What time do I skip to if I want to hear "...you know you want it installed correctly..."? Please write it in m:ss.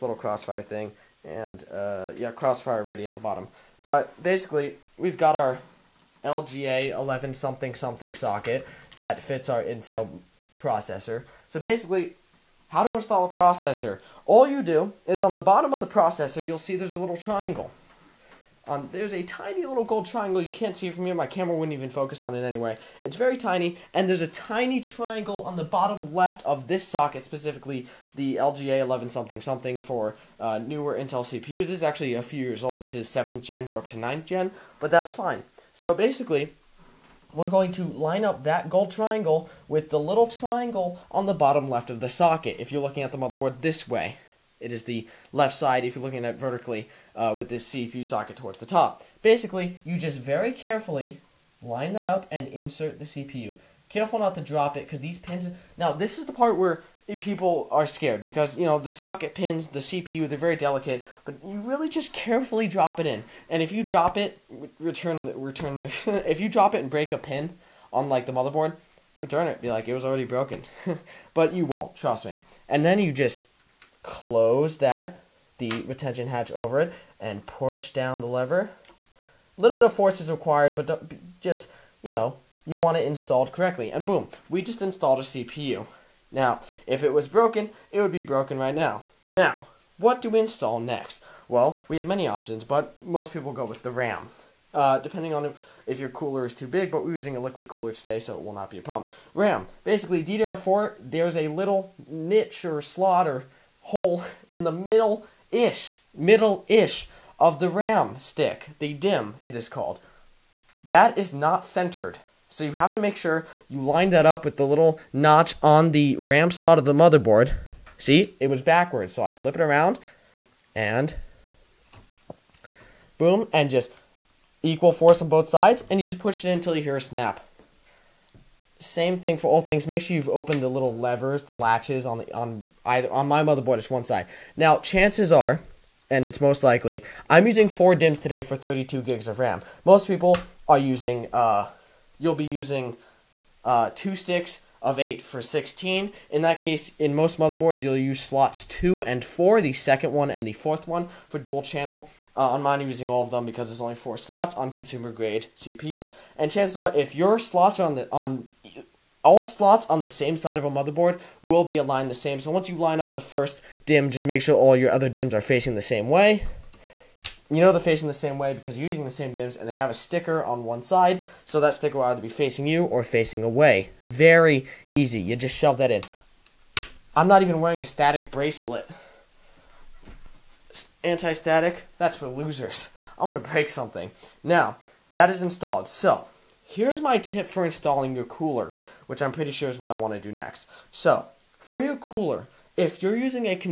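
1:22.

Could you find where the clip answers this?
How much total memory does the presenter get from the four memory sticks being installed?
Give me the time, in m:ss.
2:18.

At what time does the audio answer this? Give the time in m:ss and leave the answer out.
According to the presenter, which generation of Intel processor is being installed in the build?
0:33.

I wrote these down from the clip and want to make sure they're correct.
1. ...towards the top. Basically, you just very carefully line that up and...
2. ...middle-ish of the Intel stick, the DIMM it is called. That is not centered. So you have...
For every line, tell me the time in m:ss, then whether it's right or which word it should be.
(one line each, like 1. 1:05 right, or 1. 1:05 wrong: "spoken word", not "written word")
1. 0:48 right
2. 1:46 wrong: "RAM", not "Intel".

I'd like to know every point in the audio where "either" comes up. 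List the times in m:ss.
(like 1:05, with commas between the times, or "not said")
2:12, 2:52.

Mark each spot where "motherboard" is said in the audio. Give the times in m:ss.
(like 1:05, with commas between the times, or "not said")
0:43, 1:08, 1:56, 2:13, 2:27, 2:40.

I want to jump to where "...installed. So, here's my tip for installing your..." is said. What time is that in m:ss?
3:05.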